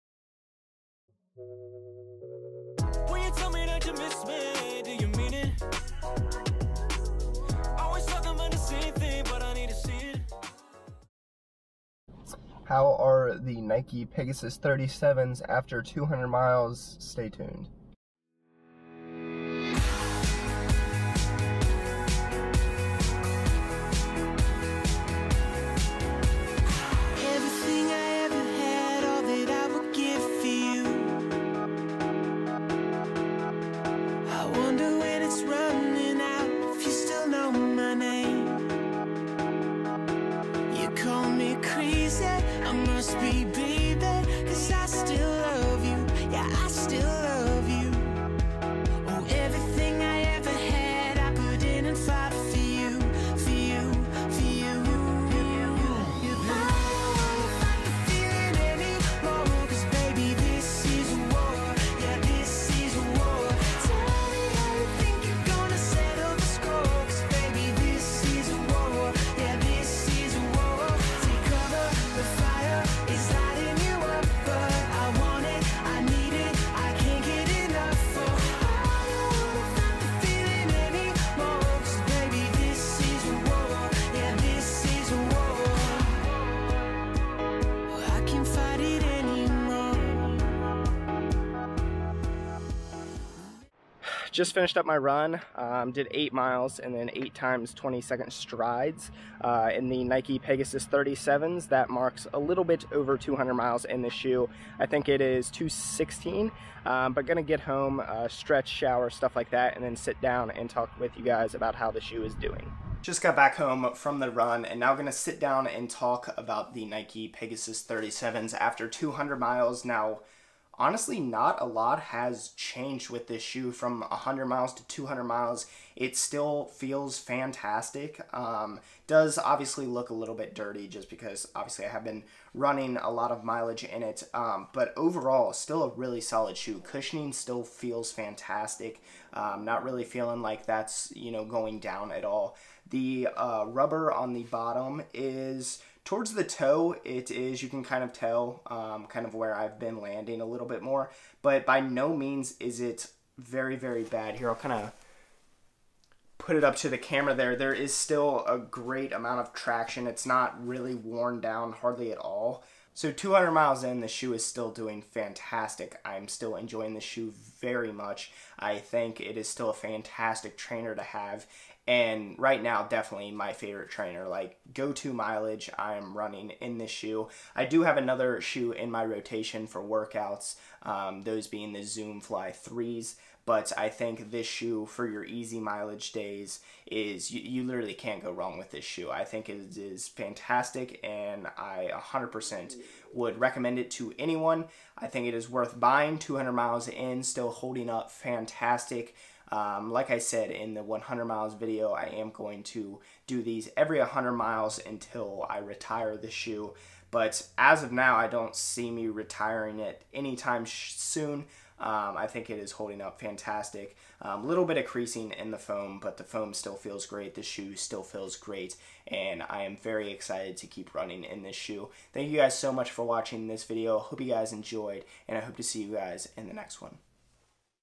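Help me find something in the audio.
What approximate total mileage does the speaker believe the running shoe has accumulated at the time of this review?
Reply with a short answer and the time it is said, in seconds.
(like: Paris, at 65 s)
216, at 105 s.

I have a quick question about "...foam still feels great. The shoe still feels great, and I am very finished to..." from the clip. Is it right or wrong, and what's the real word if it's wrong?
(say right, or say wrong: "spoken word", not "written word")
wrong: "excited", not "finished".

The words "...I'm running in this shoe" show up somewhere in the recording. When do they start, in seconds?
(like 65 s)
175 s.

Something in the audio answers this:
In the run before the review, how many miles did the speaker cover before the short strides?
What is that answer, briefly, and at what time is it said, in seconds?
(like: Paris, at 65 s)
8, at 96 s.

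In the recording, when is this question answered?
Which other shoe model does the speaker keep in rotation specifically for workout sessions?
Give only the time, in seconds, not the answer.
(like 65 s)
181 s.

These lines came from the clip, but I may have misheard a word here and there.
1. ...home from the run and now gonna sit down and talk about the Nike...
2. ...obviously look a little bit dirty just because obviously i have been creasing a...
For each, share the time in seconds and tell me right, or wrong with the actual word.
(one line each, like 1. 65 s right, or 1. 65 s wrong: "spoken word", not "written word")
1. 113 s right
2. 129 s wrong: "running", not "creasing".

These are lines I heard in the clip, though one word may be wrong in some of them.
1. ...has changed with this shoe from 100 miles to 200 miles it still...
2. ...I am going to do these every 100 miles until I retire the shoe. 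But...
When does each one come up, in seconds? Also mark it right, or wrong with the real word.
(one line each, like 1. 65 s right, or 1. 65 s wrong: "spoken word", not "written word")
1. 121 s right
2. 201 s right.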